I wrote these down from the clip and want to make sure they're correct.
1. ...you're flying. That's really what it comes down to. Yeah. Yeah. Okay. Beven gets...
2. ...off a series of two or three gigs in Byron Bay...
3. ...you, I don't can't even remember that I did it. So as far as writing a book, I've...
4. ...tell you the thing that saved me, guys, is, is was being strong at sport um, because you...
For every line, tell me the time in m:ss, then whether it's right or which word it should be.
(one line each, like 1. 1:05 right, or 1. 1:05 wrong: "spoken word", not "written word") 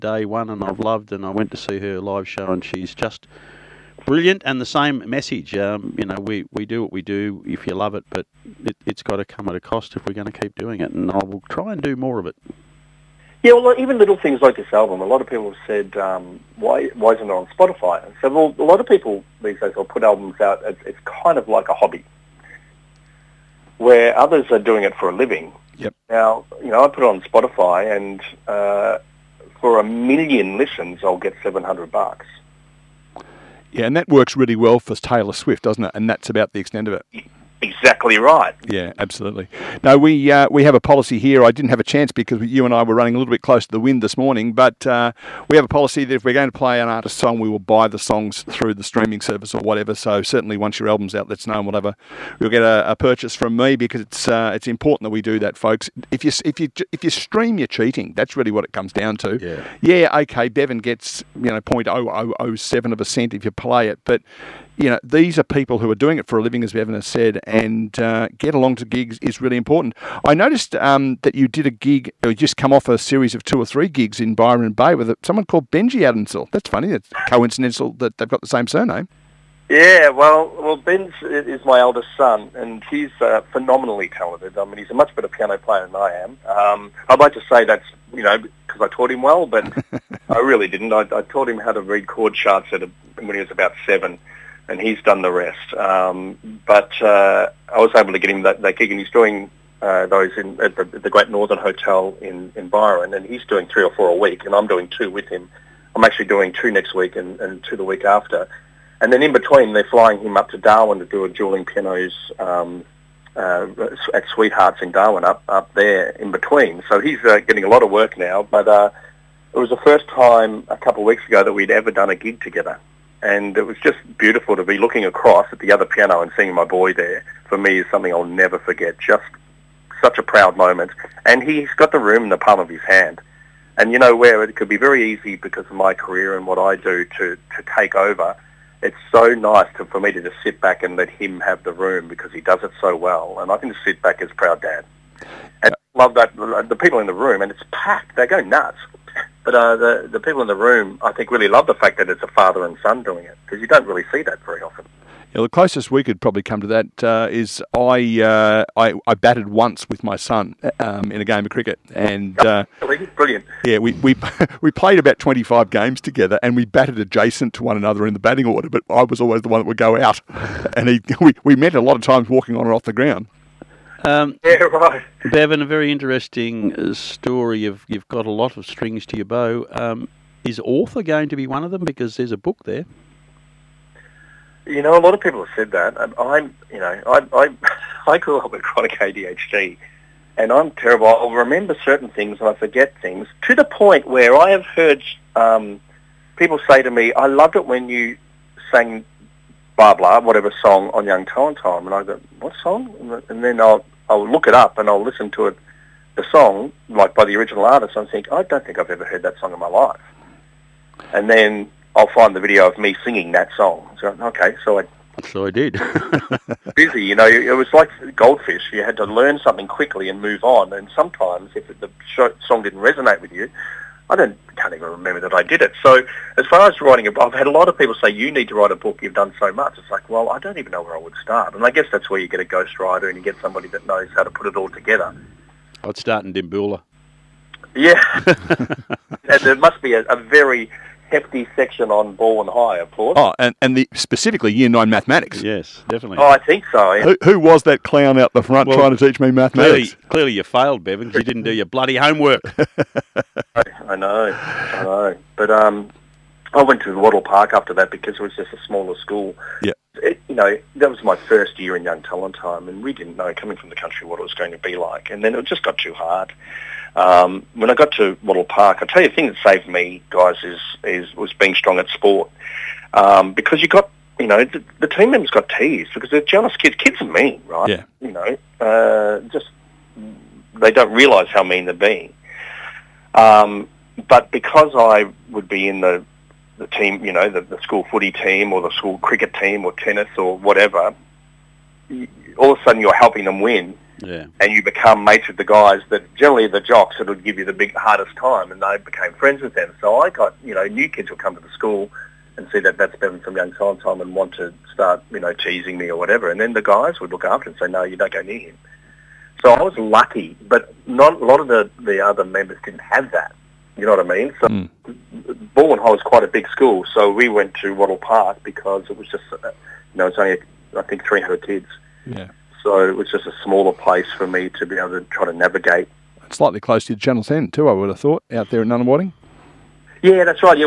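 1. 0:57 wrong: "cheating", not "flying"
2. 1:12 right
3. 3:43 right
4. 4:28 right.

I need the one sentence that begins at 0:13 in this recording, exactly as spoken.
Yeah, well, even little things like this album, a lot of people have said, um, why, why isn't it on Spotify?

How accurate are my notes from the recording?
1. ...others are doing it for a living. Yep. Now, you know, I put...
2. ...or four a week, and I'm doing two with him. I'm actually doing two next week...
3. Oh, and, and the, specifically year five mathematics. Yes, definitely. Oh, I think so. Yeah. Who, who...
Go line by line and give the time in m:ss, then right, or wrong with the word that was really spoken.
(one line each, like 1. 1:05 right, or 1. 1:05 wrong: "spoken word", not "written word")
1. 0:24 right
2. 1:43 right
3. 4:03 wrong: "nine", not "five".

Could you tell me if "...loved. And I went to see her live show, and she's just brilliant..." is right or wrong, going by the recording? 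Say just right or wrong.
right.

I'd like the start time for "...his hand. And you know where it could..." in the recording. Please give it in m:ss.
2:12.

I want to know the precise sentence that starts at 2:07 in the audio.
For me, is something I'll never forget.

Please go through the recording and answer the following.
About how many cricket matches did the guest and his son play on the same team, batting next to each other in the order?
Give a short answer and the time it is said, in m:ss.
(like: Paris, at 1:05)
25, at 2:45.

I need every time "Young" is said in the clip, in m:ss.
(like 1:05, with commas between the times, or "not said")
3:21, 4:21, 5:03.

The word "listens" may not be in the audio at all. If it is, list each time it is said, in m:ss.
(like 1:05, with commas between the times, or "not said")
0:30, 3:25.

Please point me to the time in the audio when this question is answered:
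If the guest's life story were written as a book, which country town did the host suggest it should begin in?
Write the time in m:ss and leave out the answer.
3:56.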